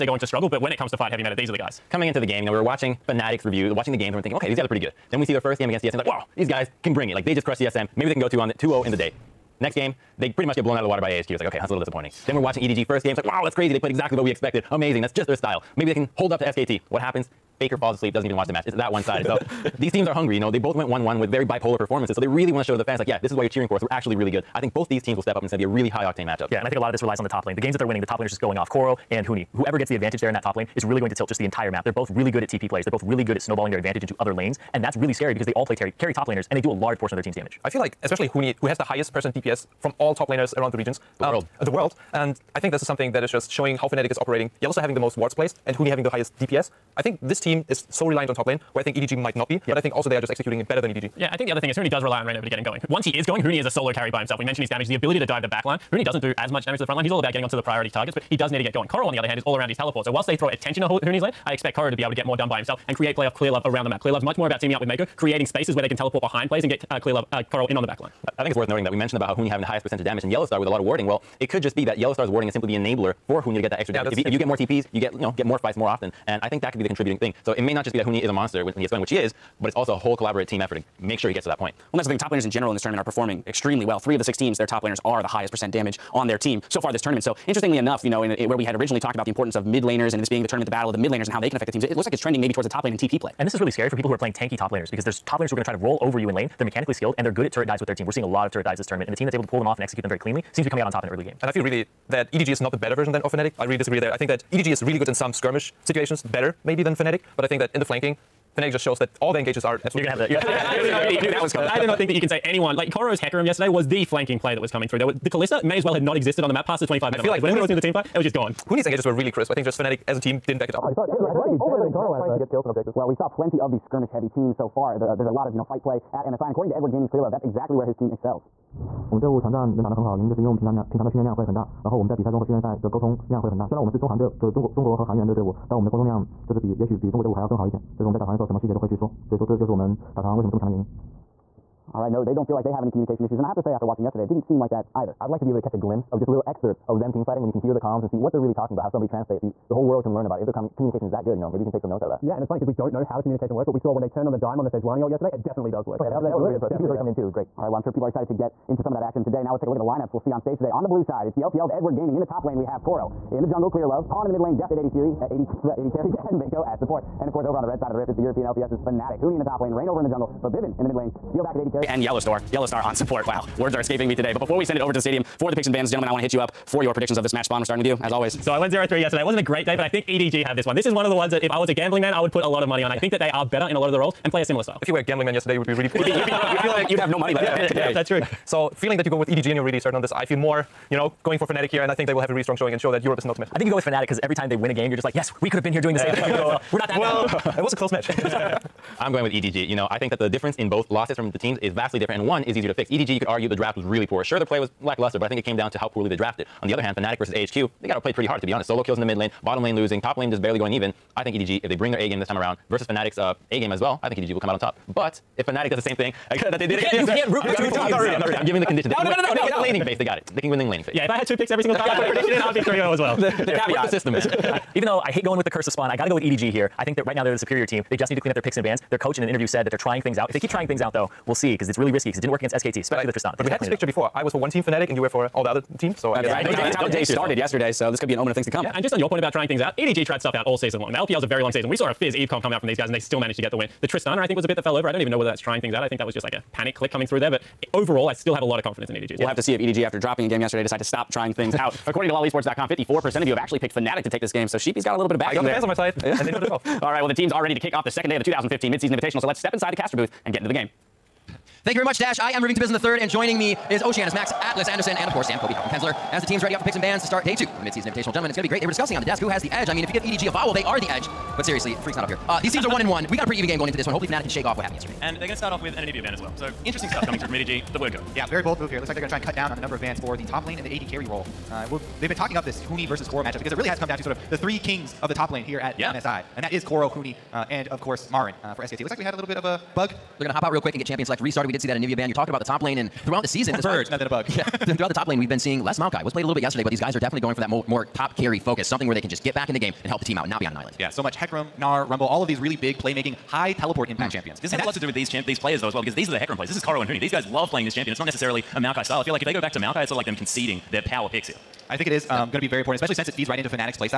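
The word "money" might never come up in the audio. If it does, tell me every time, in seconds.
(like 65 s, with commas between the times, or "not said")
182 s, 187 s.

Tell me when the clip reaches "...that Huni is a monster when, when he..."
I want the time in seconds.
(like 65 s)
77 s.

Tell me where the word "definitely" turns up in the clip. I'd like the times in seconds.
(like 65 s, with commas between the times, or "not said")
155 s, 296 s.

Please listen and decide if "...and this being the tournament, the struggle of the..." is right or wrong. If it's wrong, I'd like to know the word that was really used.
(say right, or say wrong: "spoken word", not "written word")
wrong: "battle", not "struggle".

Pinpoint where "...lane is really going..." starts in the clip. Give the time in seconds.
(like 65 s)
30 s.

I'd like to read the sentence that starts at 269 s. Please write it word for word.
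I mean, if you give EDG a vowel, they are the edge.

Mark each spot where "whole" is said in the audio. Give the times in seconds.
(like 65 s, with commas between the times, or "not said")
79 s, 149 s.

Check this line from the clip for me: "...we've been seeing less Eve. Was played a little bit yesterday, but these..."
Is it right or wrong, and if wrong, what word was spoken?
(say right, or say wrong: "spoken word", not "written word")
wrong: "Maokai", not "Eve".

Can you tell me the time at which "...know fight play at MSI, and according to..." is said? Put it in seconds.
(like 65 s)
125 s.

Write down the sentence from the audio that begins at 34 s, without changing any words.
And that's really scary because they all play terry, carry top laners and they do a large portion of their team's damage.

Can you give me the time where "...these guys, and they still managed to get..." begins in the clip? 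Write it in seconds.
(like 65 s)
242 s.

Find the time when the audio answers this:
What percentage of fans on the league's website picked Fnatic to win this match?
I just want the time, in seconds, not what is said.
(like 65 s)
252 s.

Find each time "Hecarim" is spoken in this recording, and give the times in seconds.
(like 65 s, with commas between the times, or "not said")
113 s, 301 s, 306 s.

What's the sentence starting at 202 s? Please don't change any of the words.
EDG, you could argue the draft was really poor.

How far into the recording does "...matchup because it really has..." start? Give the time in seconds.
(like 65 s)
283 s.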